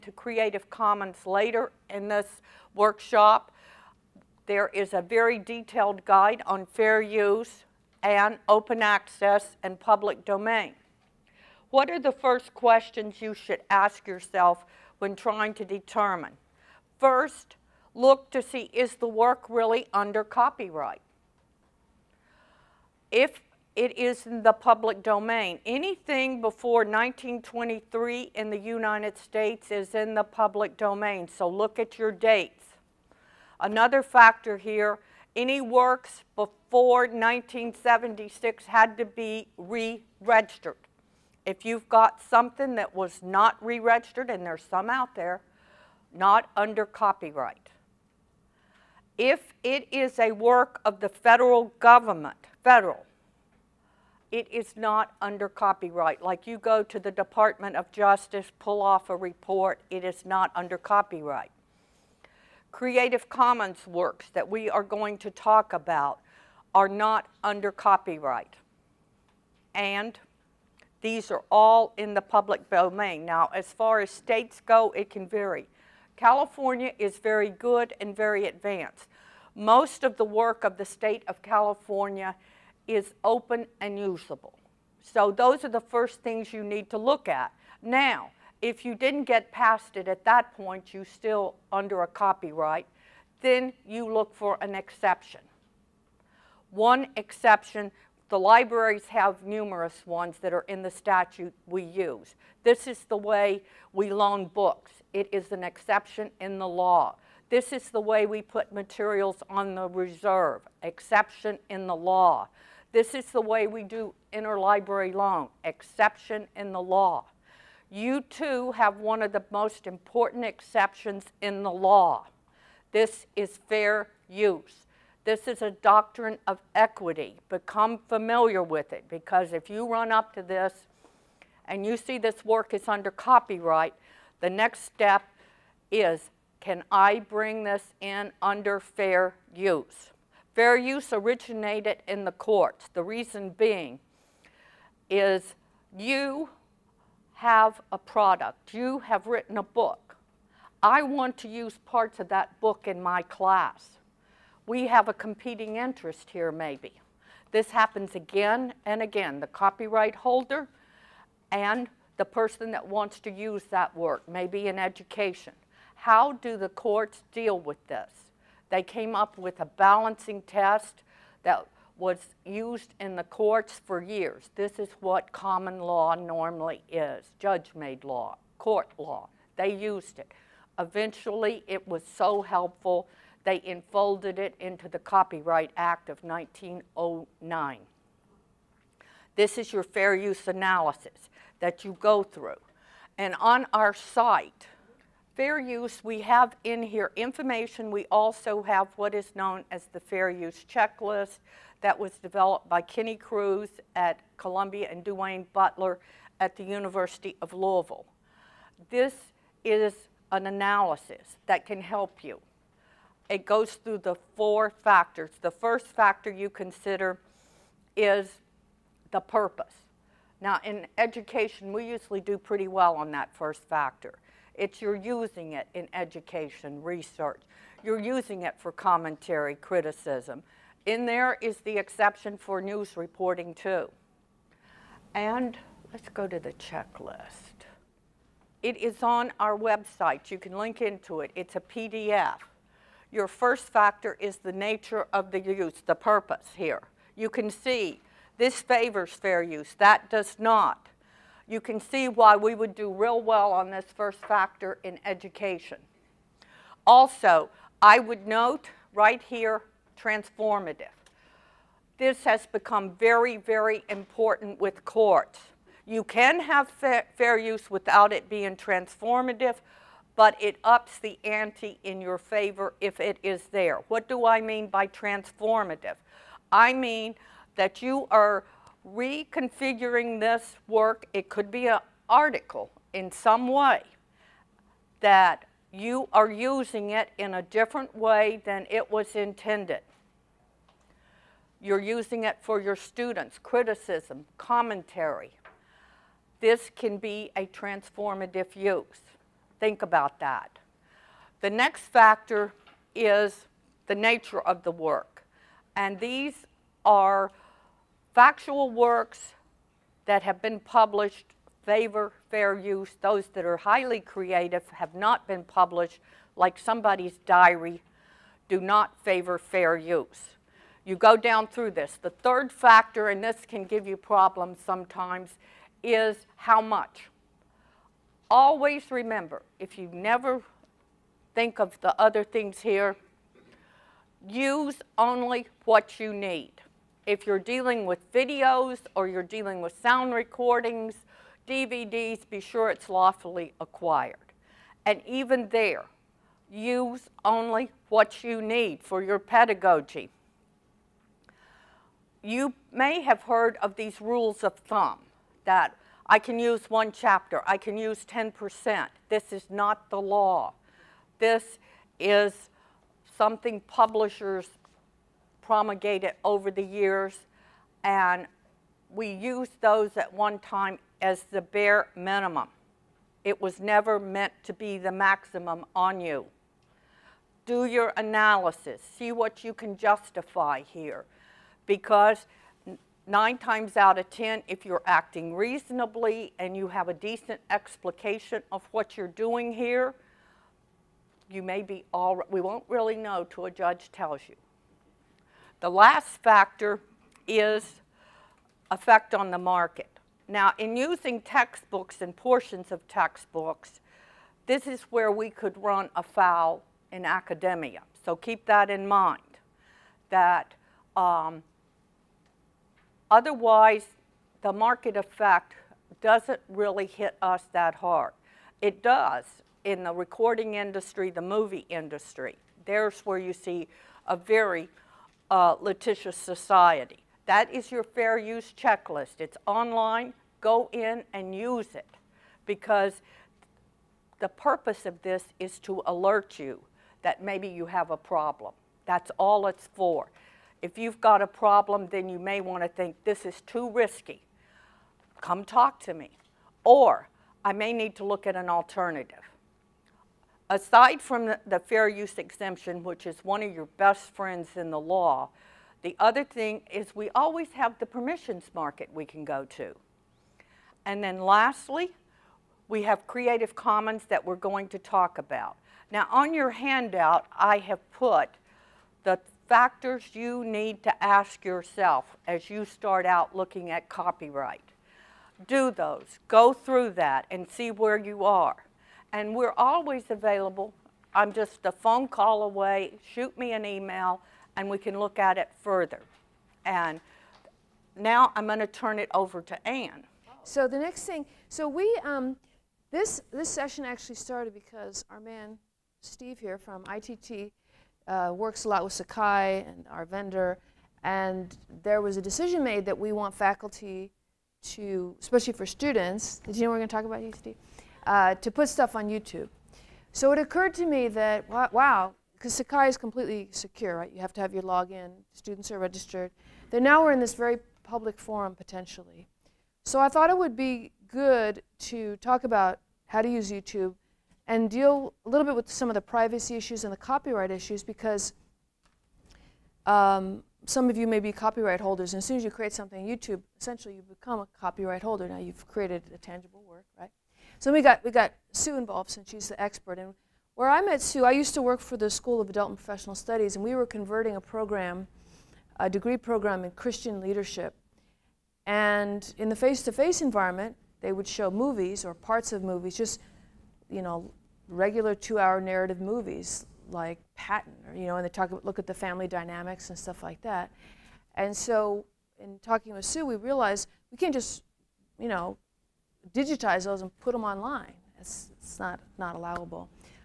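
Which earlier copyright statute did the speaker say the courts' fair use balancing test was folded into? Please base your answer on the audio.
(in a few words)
Copyright Act of 1909.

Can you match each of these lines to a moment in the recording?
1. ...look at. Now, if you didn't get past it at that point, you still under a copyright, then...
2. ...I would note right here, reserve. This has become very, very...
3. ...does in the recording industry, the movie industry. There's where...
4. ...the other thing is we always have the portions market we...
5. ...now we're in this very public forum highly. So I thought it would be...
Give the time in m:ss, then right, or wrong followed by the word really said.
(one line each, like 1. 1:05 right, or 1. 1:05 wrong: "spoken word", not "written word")
1. 1:26 right
2. 4:17 wrong: "transformative", not "reserve"
3. 6:58 right
4. 7:35 wrong: "permissions", not "portions"
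5. 8:36 wrong: "potentially", not "highly".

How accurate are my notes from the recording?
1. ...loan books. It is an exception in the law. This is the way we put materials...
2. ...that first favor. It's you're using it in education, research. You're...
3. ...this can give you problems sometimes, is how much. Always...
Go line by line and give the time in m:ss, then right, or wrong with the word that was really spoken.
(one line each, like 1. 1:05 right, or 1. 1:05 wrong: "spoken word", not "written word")
1. 1:44 right
2. 3:43 wrong: "factor", not "favor"
3. 5:23 right.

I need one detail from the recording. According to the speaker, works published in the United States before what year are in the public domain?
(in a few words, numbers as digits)
1923.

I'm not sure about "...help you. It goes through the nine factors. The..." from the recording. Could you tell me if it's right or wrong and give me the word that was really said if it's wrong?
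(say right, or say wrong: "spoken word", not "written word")
wrong: "four", not "nine".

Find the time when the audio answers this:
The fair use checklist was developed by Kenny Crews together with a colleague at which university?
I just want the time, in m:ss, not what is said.
3:26.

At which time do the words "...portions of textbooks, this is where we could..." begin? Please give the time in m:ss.
6:42.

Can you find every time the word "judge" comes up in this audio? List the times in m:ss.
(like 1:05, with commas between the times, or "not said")
2:57, 6:33.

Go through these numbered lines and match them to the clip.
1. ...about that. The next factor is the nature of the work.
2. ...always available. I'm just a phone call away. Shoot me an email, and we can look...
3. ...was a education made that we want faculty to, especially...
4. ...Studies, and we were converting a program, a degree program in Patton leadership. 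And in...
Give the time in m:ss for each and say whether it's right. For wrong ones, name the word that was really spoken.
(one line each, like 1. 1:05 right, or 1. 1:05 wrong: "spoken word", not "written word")
1. 4:59 right
2. 7:59 right
3. 8:22 wrong: "decision", not "education"
4. 9:03 wrong: "Christian", not "Patton".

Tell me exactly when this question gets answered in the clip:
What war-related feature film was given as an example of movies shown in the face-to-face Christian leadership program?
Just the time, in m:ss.
9:17.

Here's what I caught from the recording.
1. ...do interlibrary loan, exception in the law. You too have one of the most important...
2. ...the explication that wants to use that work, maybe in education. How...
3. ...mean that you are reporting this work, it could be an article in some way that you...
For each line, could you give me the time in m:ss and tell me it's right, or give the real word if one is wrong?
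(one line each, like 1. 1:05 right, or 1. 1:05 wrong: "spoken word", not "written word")
1. 1:53 right
2. 2:42 wrong: "person", not "explication"
3. 4:36 wrong: "reconfiguring", not "reporting".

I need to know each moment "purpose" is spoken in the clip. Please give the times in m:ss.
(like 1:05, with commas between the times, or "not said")
3:39, 4:05, 7:14.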